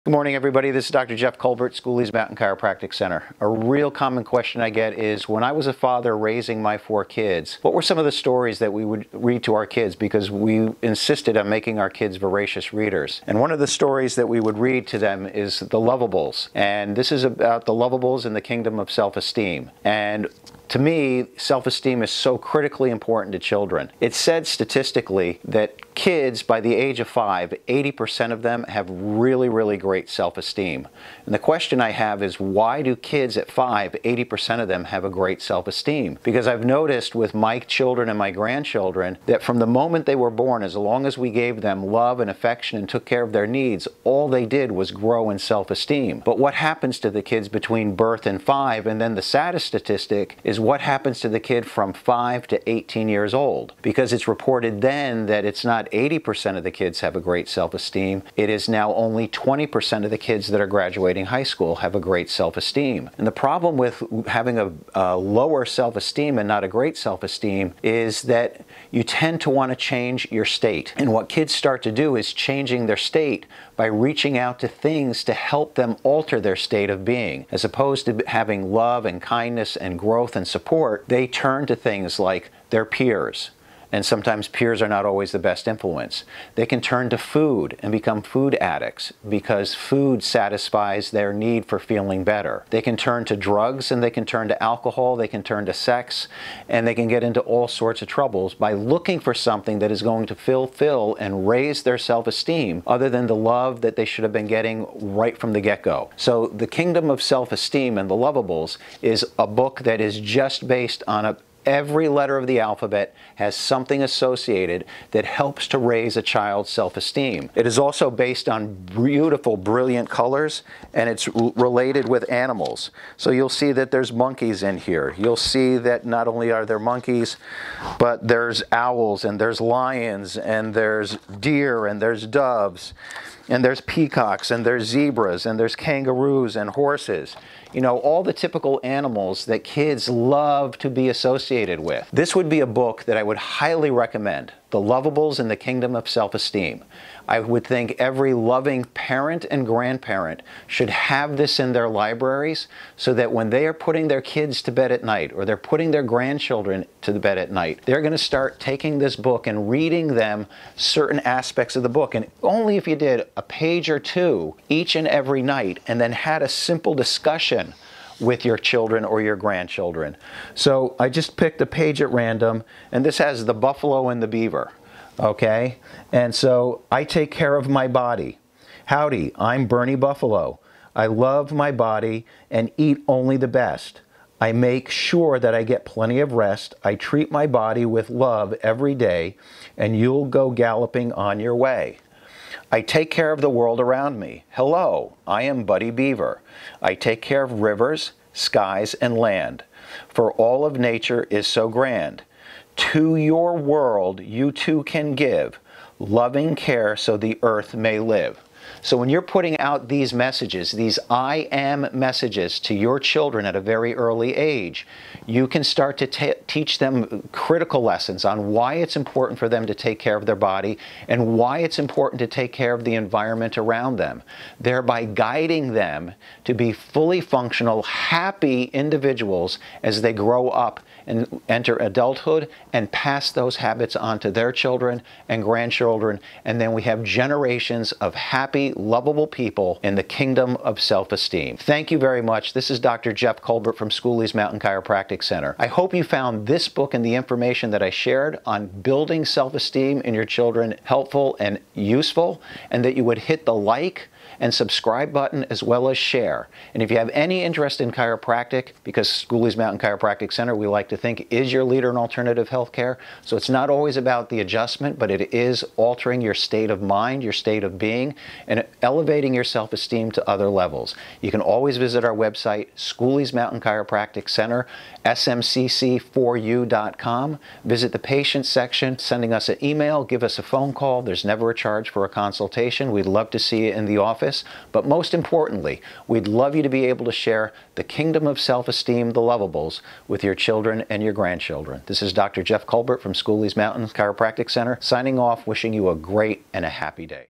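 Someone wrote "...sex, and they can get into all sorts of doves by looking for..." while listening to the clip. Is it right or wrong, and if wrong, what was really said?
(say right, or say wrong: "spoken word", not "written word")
wrong: "troubles", not "doves".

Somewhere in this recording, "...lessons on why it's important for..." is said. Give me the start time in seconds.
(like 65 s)
217 s.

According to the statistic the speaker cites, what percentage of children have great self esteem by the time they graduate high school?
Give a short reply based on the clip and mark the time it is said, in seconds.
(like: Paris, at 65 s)
20%, at 58 s.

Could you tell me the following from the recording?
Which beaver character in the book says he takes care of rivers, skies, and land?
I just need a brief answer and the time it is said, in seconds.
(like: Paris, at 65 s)
Buddy Beaver, at 195 s.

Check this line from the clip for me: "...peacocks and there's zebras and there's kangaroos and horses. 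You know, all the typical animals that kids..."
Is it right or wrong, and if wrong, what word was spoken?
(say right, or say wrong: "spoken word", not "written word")
right.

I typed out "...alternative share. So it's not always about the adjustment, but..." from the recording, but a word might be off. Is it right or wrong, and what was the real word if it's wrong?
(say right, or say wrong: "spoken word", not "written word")
wrong: "healthcare", not "share".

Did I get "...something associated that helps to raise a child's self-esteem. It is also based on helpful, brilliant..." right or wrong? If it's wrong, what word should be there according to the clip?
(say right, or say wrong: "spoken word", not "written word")
wrong: "beautiful", not "helpful".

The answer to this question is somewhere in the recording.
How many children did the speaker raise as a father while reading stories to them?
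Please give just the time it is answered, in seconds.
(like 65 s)
6 s.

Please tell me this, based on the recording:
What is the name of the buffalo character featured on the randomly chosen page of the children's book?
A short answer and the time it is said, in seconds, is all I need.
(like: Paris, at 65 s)
Bernie Buffalo, at 179 s.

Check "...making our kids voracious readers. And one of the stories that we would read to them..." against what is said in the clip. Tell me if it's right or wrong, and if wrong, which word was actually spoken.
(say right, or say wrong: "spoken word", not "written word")
right.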